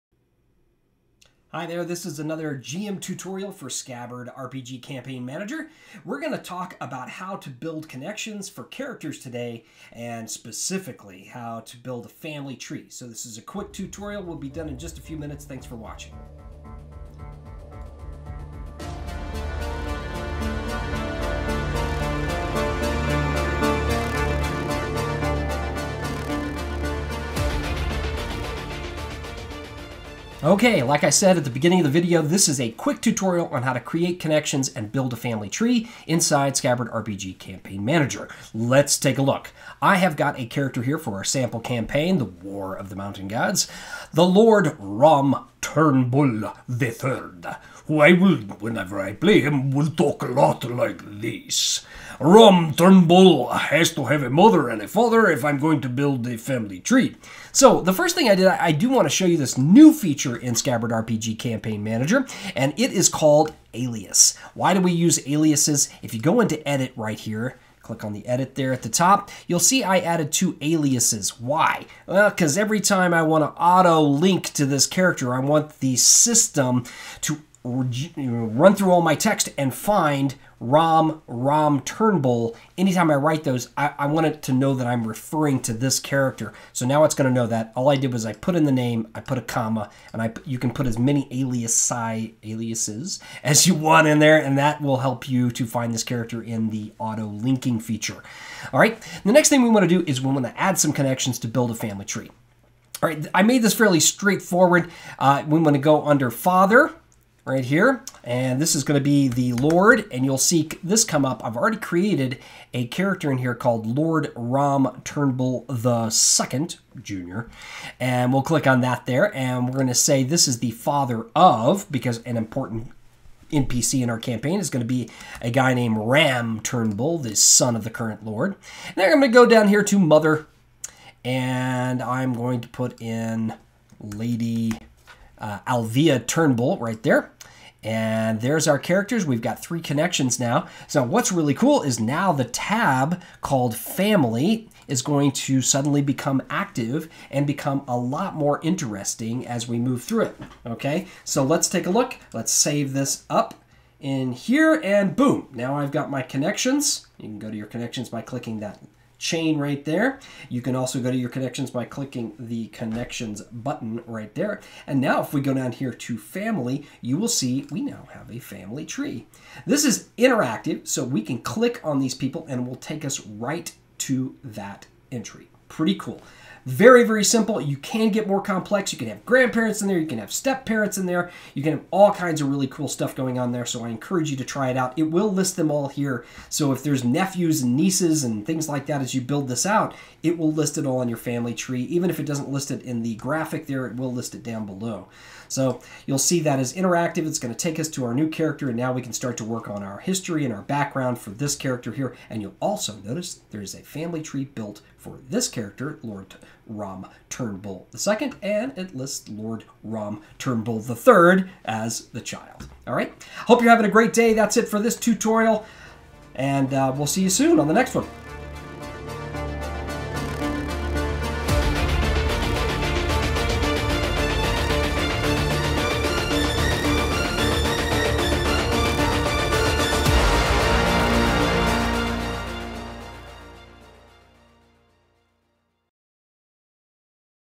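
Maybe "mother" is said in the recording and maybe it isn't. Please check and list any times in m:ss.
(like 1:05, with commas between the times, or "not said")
0:54, 2:09.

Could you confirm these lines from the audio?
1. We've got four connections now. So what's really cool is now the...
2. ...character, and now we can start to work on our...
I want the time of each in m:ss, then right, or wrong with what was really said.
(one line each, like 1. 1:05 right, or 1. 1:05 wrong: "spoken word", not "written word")
1. 2:19 wrong: "three", not "four"
2. 3:18 right.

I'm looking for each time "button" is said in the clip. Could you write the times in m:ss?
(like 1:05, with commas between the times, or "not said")
2:43.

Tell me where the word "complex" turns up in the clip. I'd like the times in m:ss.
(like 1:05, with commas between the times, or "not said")
2:58.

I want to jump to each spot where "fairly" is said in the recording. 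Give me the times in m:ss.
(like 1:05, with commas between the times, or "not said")
1:43.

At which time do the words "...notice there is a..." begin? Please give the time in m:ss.
3:23.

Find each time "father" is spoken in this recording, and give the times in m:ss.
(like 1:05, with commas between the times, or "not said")
0:54, 1:46, 2:00.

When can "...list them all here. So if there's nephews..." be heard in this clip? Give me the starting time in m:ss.
3:05.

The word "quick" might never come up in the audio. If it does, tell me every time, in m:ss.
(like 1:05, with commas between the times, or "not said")
0:13, 0:32.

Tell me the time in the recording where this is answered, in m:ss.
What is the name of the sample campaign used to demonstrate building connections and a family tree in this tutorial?
0:42.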